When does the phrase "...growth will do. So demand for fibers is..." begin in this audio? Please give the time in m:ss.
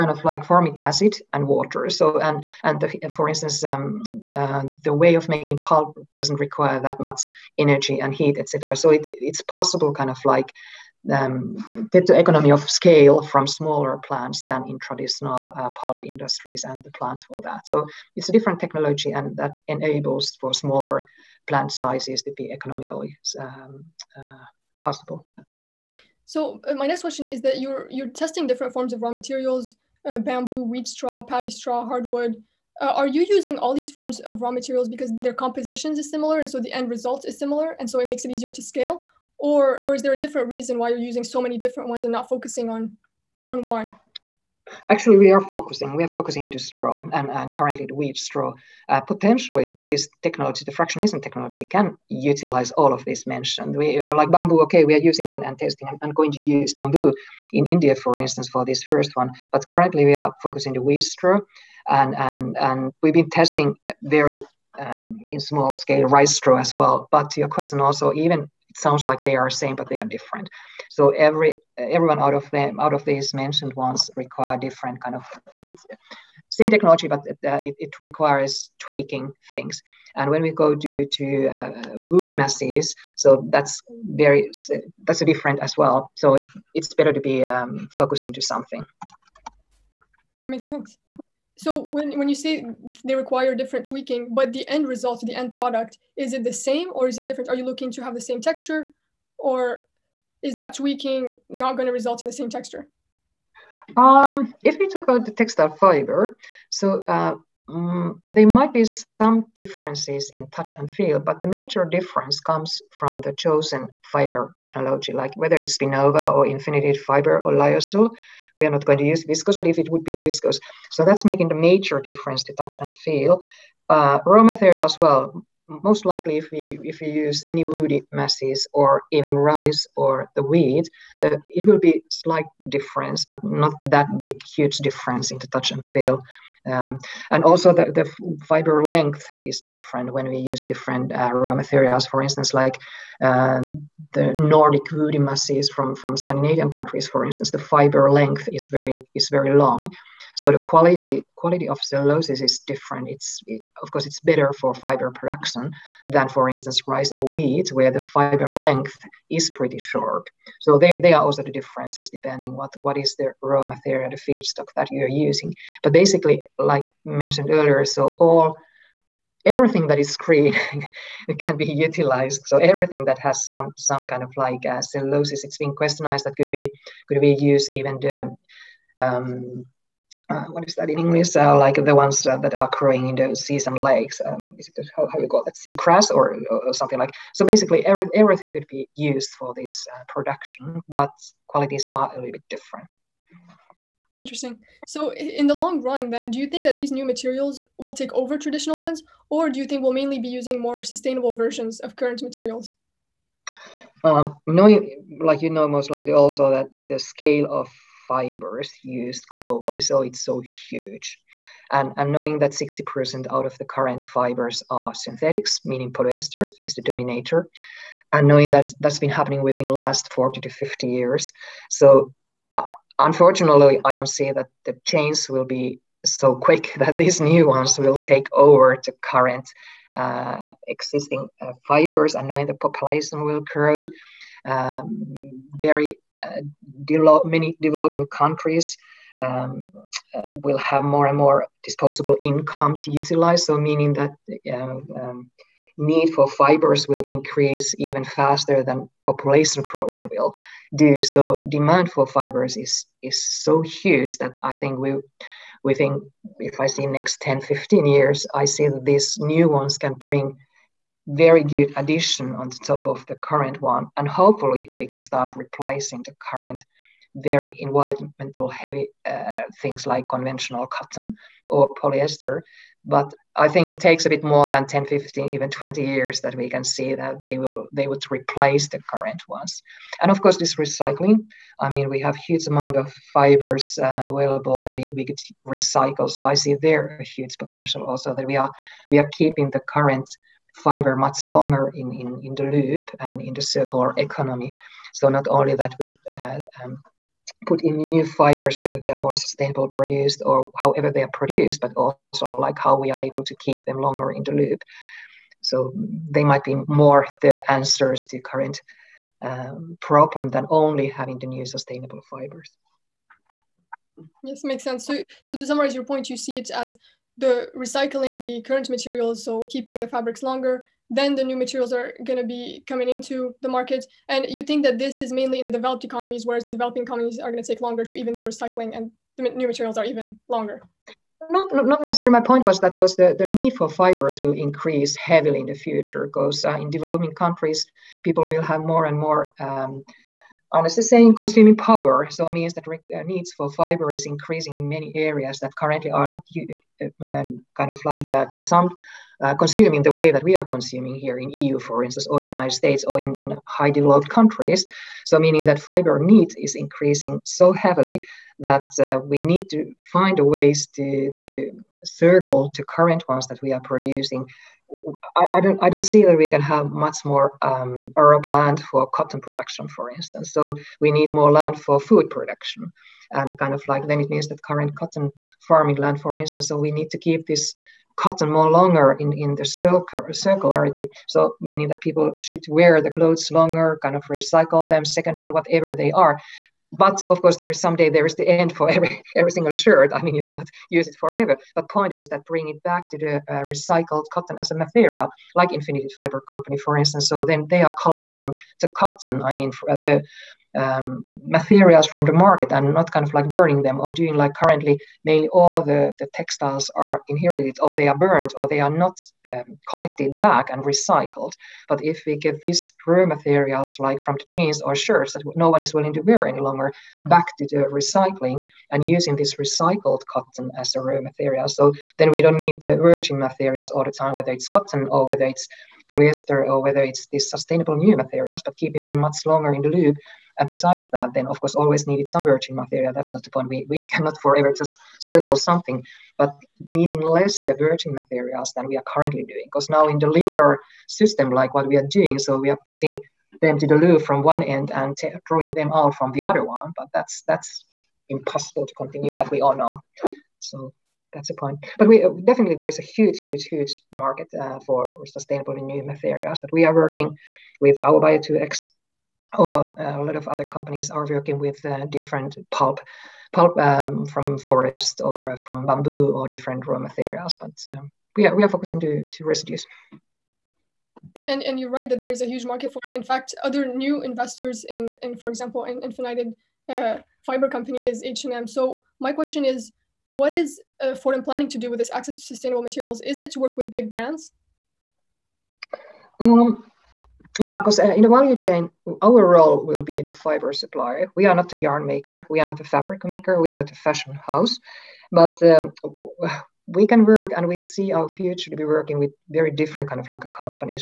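4:09.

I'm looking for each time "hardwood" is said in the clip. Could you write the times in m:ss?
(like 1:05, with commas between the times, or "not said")
0:31.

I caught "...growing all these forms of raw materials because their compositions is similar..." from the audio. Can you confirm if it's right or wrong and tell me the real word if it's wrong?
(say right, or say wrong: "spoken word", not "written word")
wrong: "using", not "growing".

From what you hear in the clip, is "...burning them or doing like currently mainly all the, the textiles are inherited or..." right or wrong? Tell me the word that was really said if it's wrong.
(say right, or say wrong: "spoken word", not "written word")
right.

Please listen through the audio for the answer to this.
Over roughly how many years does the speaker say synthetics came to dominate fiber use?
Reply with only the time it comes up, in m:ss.
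3:40.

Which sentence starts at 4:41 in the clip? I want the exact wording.
I mean, we have huge amount of fibers uh, available that we, we could recycle.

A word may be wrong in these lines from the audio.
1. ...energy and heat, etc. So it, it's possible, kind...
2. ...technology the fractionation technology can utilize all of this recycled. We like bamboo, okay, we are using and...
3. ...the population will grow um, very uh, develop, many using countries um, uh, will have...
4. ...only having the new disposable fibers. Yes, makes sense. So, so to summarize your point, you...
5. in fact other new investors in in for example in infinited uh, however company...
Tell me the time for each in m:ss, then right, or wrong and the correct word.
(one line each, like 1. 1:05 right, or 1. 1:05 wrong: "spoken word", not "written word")
1. 0:07 right
2. 0:50 wrong: "mentioned", not "recycled"
3. 3:52 wrong: "developing", not "using"
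4. 5:10 wrong: "sustainable", not "disposable"
5. 7:52 wrong: "fiber", not "however".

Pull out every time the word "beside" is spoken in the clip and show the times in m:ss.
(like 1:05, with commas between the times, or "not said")
7:10.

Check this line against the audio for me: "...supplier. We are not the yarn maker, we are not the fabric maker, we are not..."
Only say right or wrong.
right.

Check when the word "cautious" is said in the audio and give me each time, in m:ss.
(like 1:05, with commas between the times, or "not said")
not said.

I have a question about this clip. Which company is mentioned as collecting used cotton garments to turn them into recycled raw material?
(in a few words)
Infinited Fiber.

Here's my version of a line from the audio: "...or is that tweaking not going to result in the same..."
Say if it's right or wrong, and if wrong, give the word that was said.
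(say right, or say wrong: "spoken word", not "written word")
right.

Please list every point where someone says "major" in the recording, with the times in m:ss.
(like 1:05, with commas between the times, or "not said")
1:51, 2:01.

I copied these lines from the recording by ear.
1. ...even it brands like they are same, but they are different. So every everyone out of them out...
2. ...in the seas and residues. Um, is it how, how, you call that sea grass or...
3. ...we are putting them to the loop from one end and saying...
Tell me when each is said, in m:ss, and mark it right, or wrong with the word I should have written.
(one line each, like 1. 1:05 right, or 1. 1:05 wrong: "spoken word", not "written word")
1. 1:08 wrong: "sounds", not "brands"
2. 3:03 wrong: "lakes", not "residues"
3. 7:22 wrong: "drawing", not "saying".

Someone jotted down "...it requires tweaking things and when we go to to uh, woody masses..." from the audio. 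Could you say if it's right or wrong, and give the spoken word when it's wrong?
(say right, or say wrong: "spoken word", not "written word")
right.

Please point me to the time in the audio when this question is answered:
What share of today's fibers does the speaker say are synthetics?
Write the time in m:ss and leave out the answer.
3:32.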